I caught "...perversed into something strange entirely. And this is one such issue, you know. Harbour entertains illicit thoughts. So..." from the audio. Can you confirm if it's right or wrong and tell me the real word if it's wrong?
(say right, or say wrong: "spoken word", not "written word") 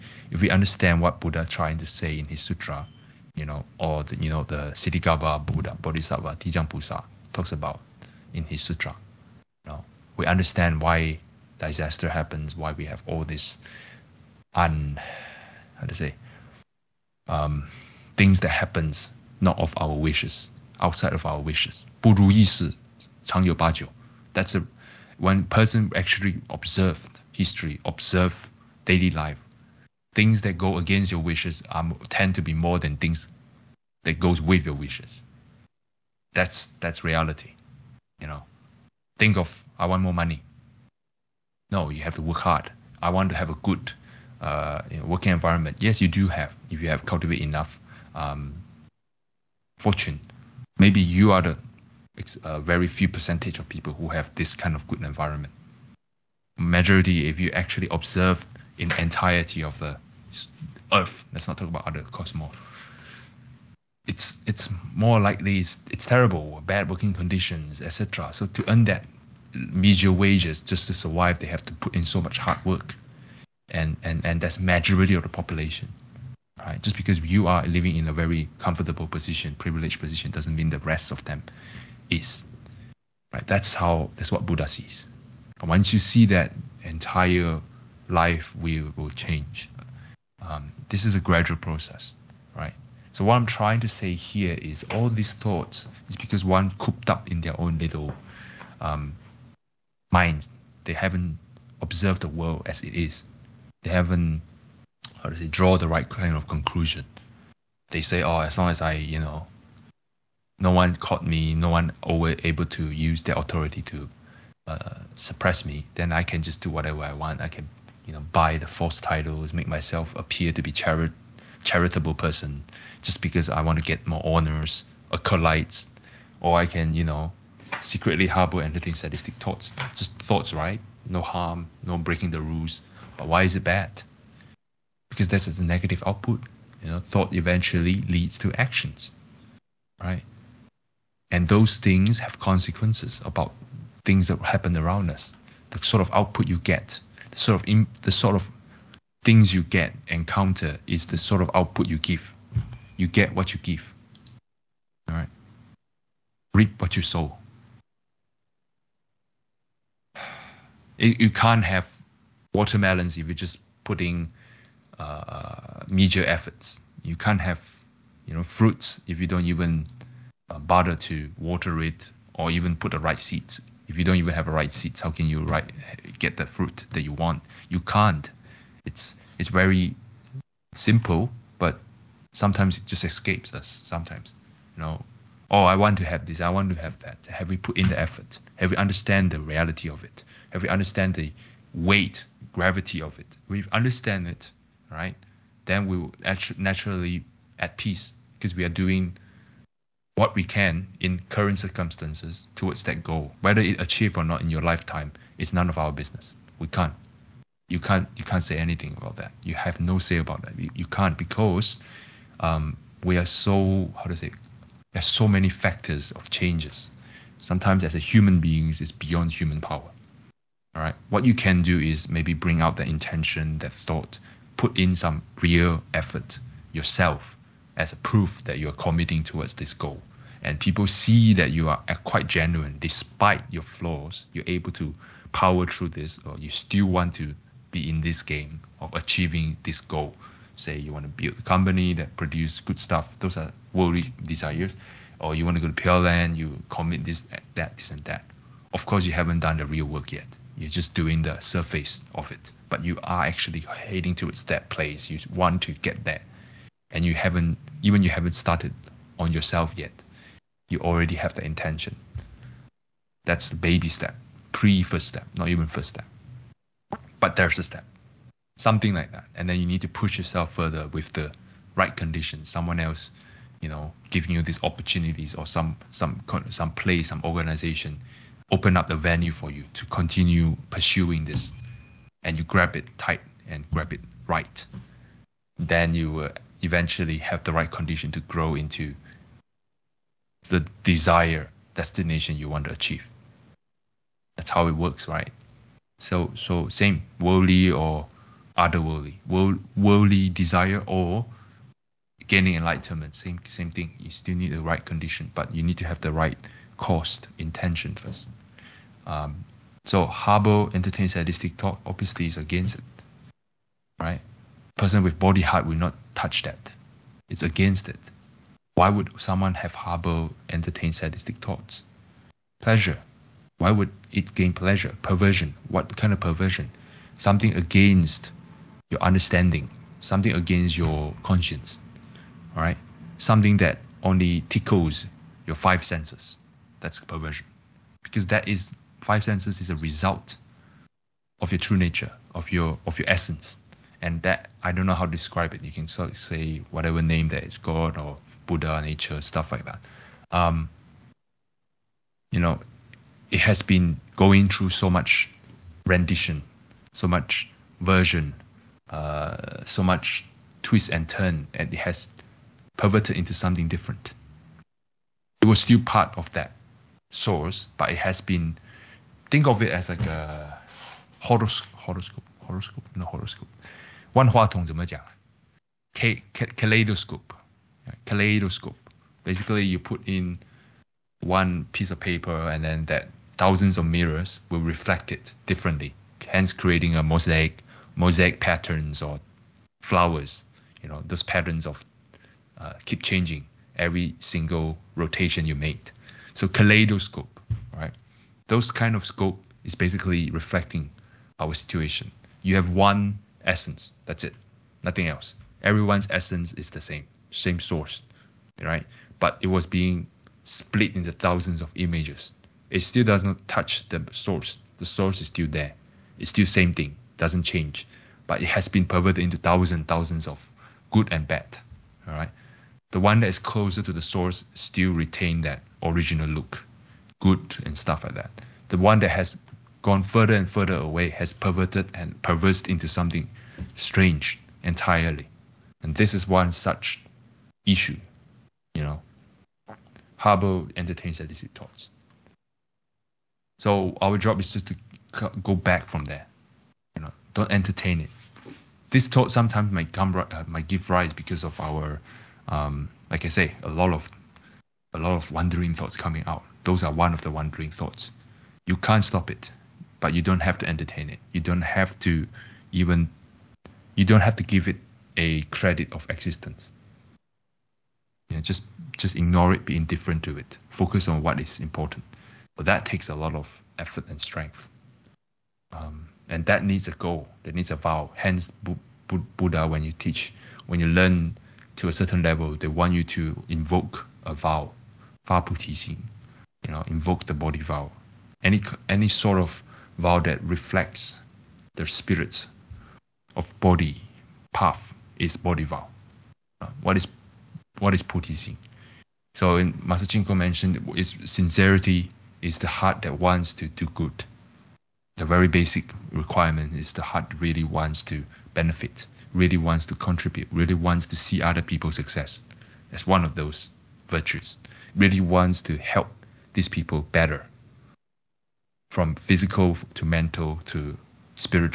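right.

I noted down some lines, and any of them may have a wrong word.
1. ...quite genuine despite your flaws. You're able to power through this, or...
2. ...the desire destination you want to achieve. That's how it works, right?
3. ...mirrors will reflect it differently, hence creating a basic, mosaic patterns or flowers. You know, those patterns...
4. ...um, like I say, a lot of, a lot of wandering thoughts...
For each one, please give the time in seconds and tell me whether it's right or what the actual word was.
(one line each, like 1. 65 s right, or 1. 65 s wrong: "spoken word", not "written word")
1. 232 s right
2. 290 s right
3. 383 s wrong: "mosaic", not "basic"
4. 452 s right.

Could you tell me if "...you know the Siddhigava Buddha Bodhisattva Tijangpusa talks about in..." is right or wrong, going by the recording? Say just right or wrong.
right.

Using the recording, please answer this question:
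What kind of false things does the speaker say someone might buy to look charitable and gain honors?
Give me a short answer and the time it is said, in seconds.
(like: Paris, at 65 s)
false titles, at 118 s.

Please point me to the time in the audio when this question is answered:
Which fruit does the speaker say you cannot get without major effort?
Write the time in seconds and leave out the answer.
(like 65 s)
162 s.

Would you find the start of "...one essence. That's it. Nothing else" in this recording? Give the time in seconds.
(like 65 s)
402 s.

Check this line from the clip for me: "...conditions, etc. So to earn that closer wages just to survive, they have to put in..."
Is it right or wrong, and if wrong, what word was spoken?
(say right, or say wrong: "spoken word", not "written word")
wrong: "meager", not "closer".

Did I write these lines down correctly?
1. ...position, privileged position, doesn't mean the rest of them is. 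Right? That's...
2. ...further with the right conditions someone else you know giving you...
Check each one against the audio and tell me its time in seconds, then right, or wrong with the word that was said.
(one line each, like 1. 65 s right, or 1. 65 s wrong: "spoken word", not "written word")
1. 79 s right
2. 270 s right.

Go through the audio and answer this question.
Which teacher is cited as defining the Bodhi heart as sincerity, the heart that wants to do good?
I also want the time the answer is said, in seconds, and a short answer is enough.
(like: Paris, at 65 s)
Master Ching Kong, at 499 s.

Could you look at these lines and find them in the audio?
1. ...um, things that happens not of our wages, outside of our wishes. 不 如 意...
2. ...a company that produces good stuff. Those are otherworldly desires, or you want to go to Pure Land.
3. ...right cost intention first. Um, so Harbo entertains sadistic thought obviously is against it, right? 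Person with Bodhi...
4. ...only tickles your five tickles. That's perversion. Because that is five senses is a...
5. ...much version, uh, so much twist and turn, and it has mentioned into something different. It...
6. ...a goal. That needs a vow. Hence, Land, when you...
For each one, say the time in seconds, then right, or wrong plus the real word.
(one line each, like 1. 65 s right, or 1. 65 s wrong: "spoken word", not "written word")
1. 17 s wrong: "wishes", not "wages"
2. 241 s wrong: "worldly", not "otherworldly"
3. 306 s right
4. 334 s wrong: "senses", not "tickles"
5. 357 s wrong: "perverted", not "mentioned"
6. 476 s wrong: "Buddha", not "Land".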